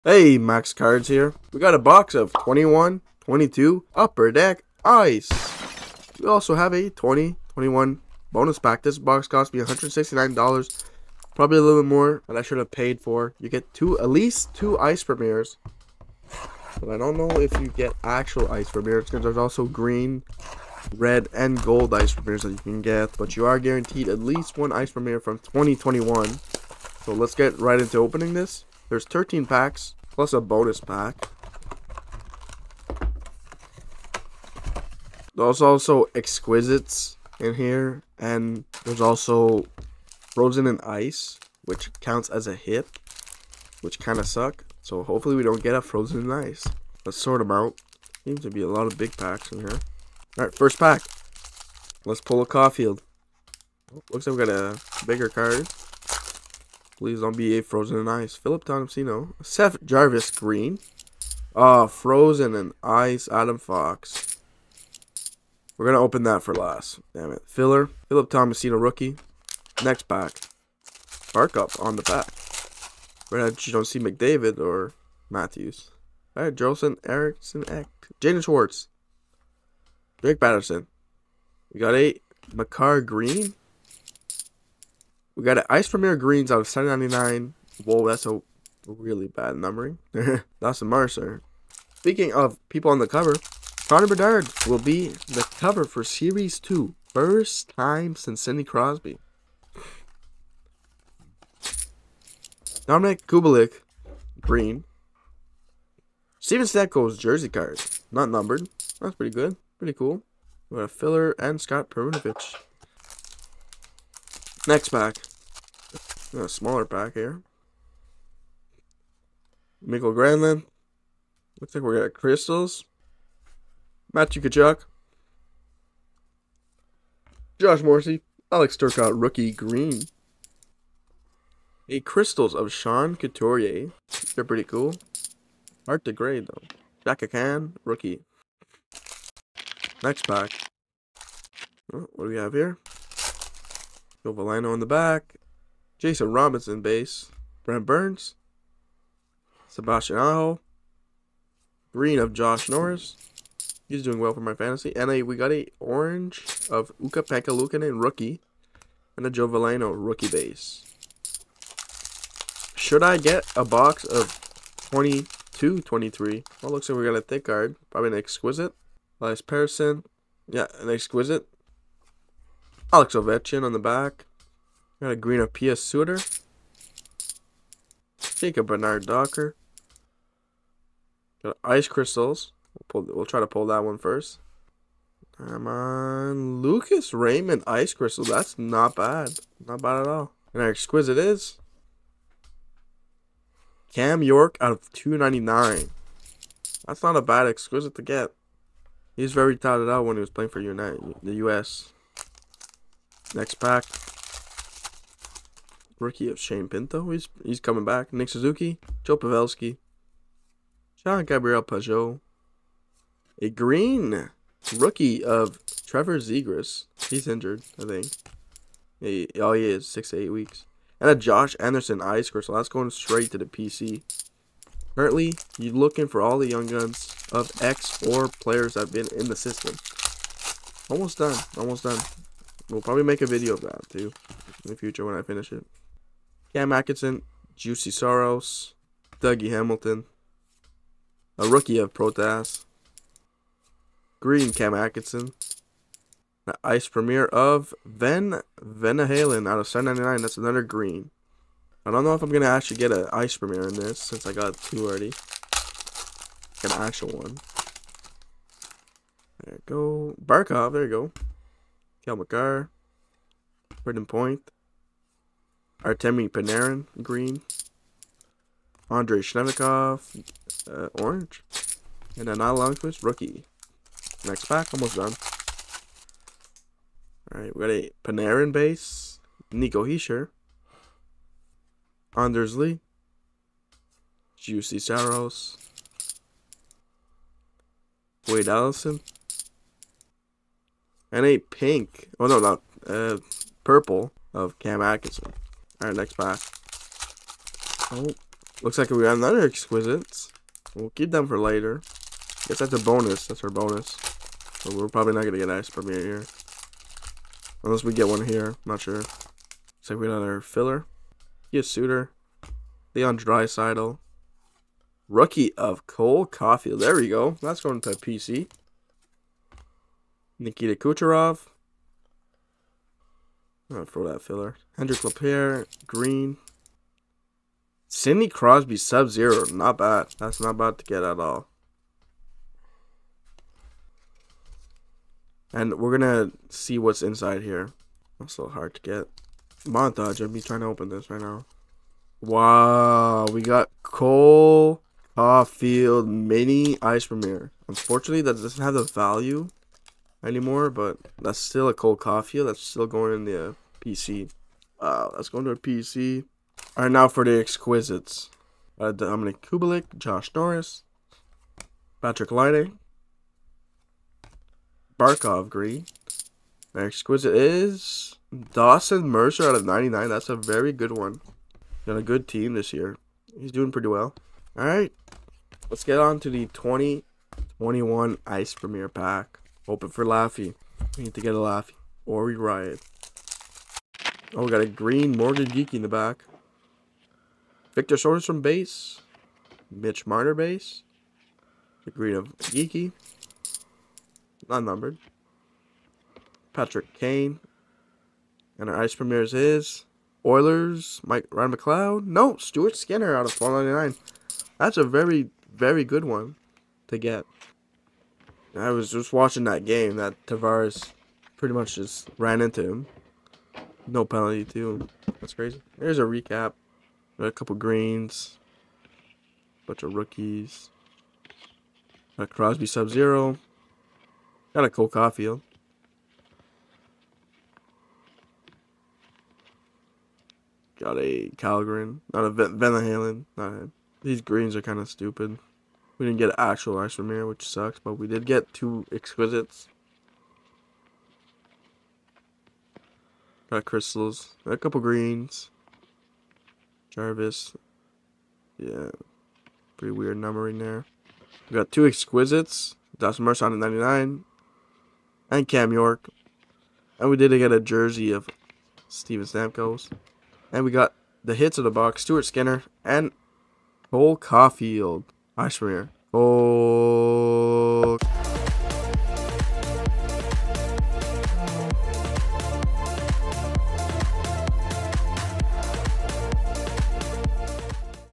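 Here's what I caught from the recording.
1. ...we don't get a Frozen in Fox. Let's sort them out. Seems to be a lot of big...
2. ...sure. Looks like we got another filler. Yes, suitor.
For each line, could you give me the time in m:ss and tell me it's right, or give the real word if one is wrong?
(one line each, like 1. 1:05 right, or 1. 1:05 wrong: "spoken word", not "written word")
1. 0:45 wrong: "Ice", not "Fox"
2. 5:08 right.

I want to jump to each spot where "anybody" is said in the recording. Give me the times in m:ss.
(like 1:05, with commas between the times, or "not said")
not said.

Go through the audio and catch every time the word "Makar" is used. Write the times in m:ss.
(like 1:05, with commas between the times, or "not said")
1:22, 4:22.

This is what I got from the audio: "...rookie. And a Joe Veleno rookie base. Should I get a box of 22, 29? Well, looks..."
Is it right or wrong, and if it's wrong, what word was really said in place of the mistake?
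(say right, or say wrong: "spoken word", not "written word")
wrong: "23", not "29".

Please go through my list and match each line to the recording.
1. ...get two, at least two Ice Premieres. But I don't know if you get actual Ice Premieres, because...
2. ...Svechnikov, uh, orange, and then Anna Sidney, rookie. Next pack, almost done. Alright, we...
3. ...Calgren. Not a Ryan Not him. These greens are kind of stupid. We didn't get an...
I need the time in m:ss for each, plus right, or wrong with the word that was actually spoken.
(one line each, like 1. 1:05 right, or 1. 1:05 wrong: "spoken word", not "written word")
1. 0:13 right
2. 4:29 wrong: "Longquist", not "Sidney"
3. 7:11 wrong: "Van", not "Ryan".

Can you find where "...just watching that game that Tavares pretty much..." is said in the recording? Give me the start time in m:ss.
6:48.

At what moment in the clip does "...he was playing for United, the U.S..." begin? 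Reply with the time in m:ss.
3:20.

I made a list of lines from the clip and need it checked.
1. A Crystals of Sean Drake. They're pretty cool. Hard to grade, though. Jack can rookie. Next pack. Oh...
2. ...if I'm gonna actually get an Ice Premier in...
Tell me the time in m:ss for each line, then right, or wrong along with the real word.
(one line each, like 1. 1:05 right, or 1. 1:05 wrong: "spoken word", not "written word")
1. 2:11 wrong: "Couturier", not "Drake"
2. 4:12 right.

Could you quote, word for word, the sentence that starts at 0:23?
But you are guaranteed at least one Ice Premiere from 2021.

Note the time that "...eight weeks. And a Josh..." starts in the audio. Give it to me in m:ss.
3:40.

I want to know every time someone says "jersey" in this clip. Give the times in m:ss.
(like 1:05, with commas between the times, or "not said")
1:47, 7:37.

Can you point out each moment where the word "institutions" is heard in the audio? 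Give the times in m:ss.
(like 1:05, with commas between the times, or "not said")
not said.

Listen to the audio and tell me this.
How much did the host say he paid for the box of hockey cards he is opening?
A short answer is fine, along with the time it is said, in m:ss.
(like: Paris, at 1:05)
$169, at 0:09.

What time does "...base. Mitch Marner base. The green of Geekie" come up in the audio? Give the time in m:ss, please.
6:28.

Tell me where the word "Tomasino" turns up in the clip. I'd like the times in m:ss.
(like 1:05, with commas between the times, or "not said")
0:58, 1:08.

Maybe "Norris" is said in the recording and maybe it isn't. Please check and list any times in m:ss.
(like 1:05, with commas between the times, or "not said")
2:32, 6:00.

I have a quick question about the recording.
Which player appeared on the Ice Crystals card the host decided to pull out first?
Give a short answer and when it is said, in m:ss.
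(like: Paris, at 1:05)
Lucas Raymond, at 3:06.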